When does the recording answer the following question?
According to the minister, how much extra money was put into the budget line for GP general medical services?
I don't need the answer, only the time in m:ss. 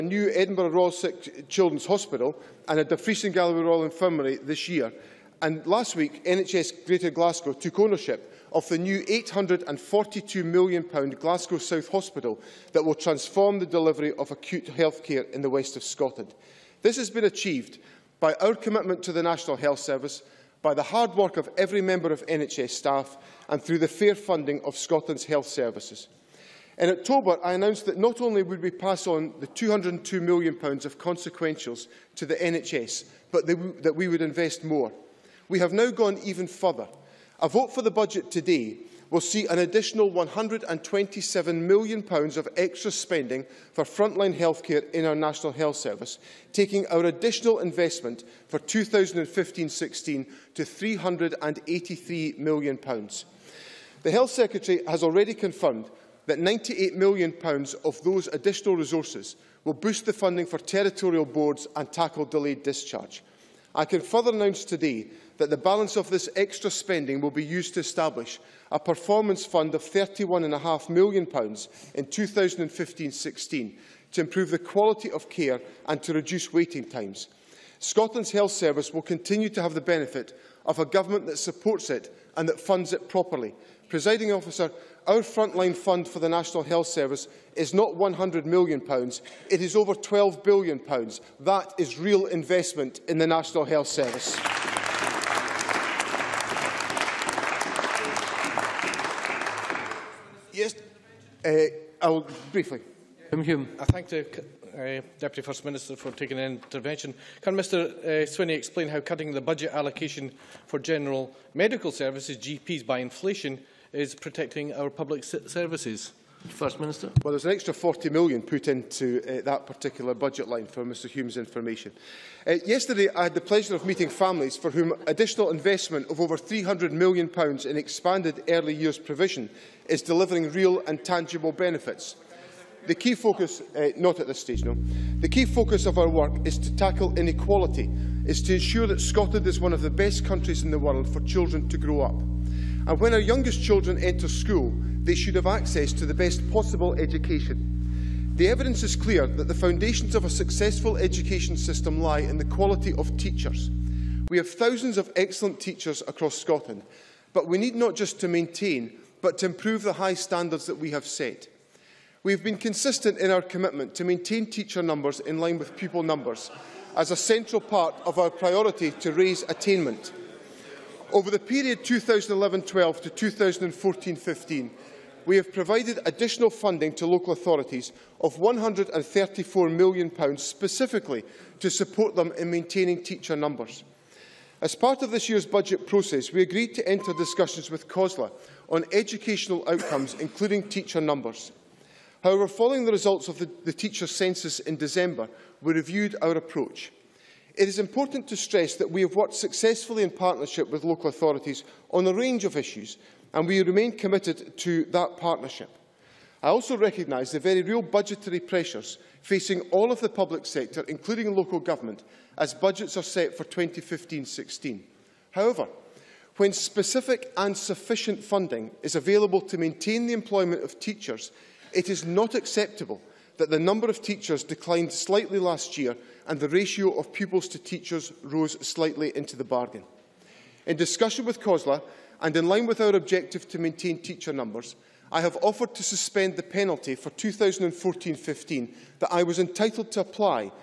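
1:57.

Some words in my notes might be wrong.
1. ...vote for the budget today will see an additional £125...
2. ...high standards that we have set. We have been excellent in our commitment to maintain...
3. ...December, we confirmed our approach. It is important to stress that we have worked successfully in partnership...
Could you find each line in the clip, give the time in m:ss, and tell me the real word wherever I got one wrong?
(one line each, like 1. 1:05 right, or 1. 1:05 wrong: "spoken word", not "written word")
1. 0:37 wrong: "127", not "125"
2. 2:39 wrong: "consistent", not "excellent"
3. 3:14 wrong: "reviewed", not "confirmed".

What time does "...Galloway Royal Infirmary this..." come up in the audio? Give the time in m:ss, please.
0:03.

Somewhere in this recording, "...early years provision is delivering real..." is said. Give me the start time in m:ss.
2:08.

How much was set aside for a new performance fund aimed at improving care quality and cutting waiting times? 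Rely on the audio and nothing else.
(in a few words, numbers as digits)
£31.5 million.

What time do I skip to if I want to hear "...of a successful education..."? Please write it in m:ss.
2:30.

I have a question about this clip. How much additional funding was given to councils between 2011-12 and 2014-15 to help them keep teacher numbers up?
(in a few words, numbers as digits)
£134 million.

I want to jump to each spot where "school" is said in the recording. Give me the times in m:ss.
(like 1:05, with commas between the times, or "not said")
2:24.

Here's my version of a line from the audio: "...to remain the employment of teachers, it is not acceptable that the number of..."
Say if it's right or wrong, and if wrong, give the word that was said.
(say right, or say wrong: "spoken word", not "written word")
wrong: "maintain", not "remain".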